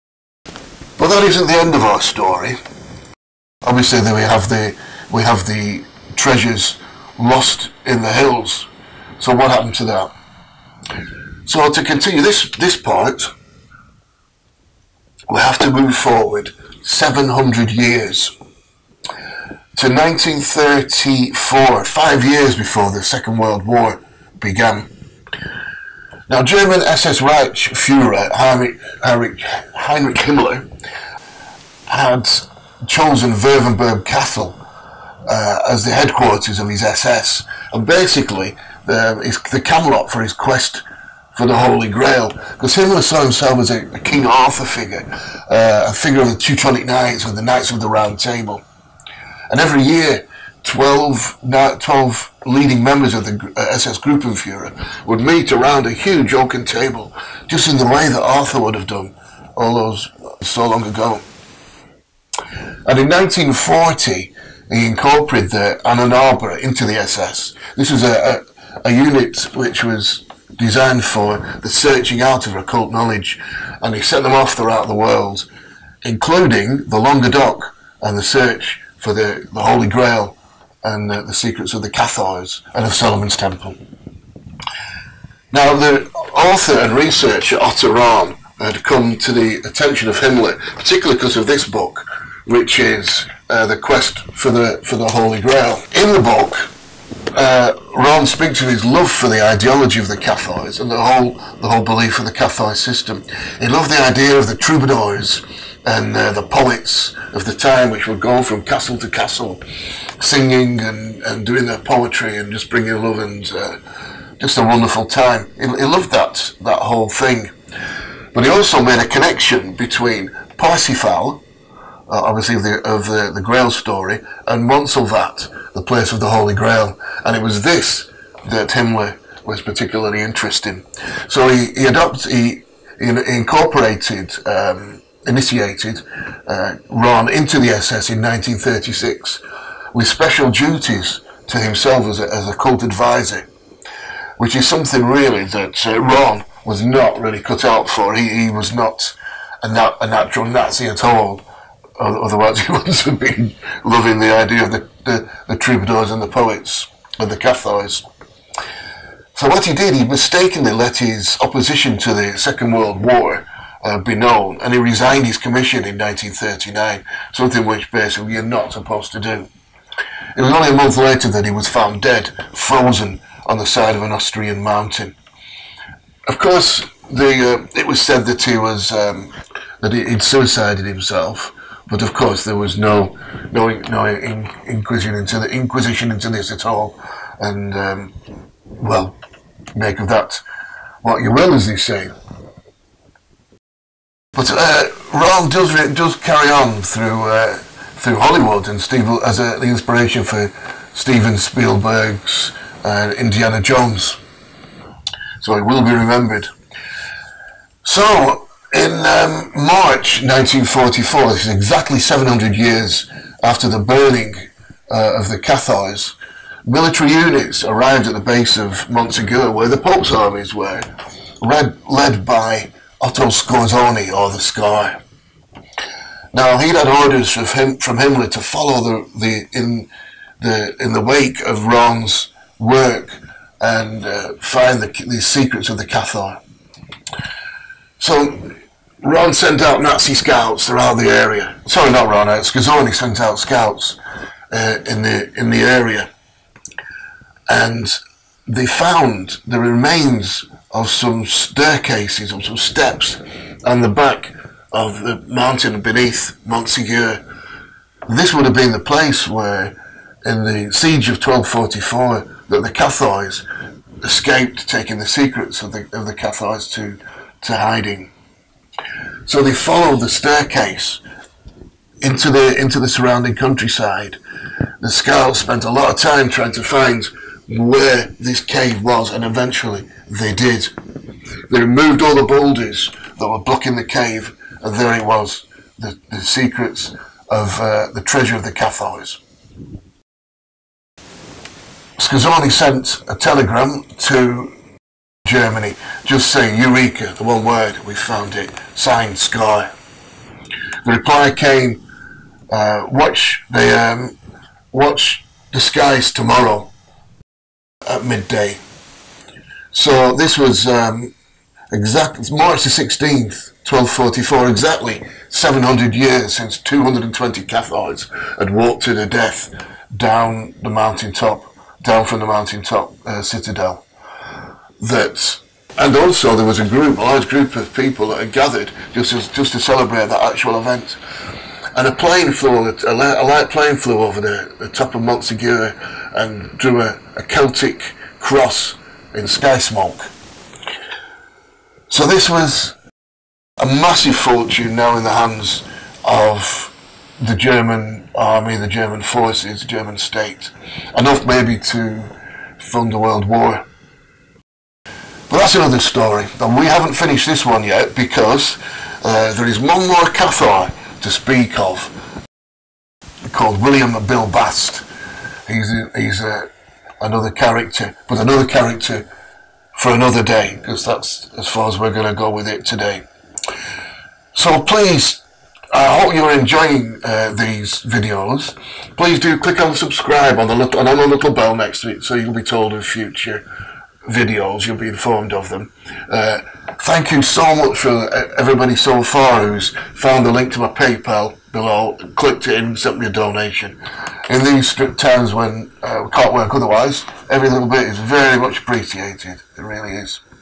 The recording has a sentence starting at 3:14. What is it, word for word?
But uh, Rahn does does carry on through uh, through Hollywood and Steve as the inspiration for Steven Spielberg's uh, Indiana Jones.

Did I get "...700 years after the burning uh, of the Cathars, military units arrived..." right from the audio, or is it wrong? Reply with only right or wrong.
right.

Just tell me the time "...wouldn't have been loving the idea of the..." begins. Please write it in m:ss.
2:32.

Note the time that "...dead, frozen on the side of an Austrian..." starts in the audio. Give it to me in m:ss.
2:52.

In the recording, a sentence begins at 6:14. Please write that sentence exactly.
So please, I hope you're enjoying uh, these videos.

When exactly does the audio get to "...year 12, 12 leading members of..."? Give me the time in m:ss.
0:49.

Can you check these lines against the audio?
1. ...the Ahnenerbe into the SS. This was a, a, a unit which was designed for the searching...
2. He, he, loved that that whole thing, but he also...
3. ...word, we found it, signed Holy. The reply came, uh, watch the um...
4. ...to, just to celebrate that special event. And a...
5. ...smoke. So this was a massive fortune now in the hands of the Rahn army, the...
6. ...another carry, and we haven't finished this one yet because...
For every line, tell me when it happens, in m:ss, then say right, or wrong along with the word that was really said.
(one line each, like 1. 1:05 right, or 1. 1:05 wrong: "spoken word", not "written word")
1. 1:05 right
2. 1:55 right
3. 4:57 wrong: "Sky", not "Holy"
4. 5:29 wrong: "actual", not "special"
5. 5:39 wrong: "German", not "Rahn"
6. 5:55 wrong: "story", not "carry".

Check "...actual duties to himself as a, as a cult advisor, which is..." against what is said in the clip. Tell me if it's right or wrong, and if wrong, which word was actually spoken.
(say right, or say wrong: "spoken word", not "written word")
wrong: "special", not "actual".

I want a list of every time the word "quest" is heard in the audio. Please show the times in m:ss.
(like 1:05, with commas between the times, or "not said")
0:40, 1:33.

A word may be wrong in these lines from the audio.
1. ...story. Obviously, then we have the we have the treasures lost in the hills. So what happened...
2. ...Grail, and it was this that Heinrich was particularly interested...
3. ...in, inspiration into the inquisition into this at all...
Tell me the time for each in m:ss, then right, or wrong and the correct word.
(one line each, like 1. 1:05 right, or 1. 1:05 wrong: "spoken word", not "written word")
1. 0:01 right
2. 2:06 wrong: "Himmler", not "Heinrich"
3. 3:04 wrong: "inquisition", not "inspiration".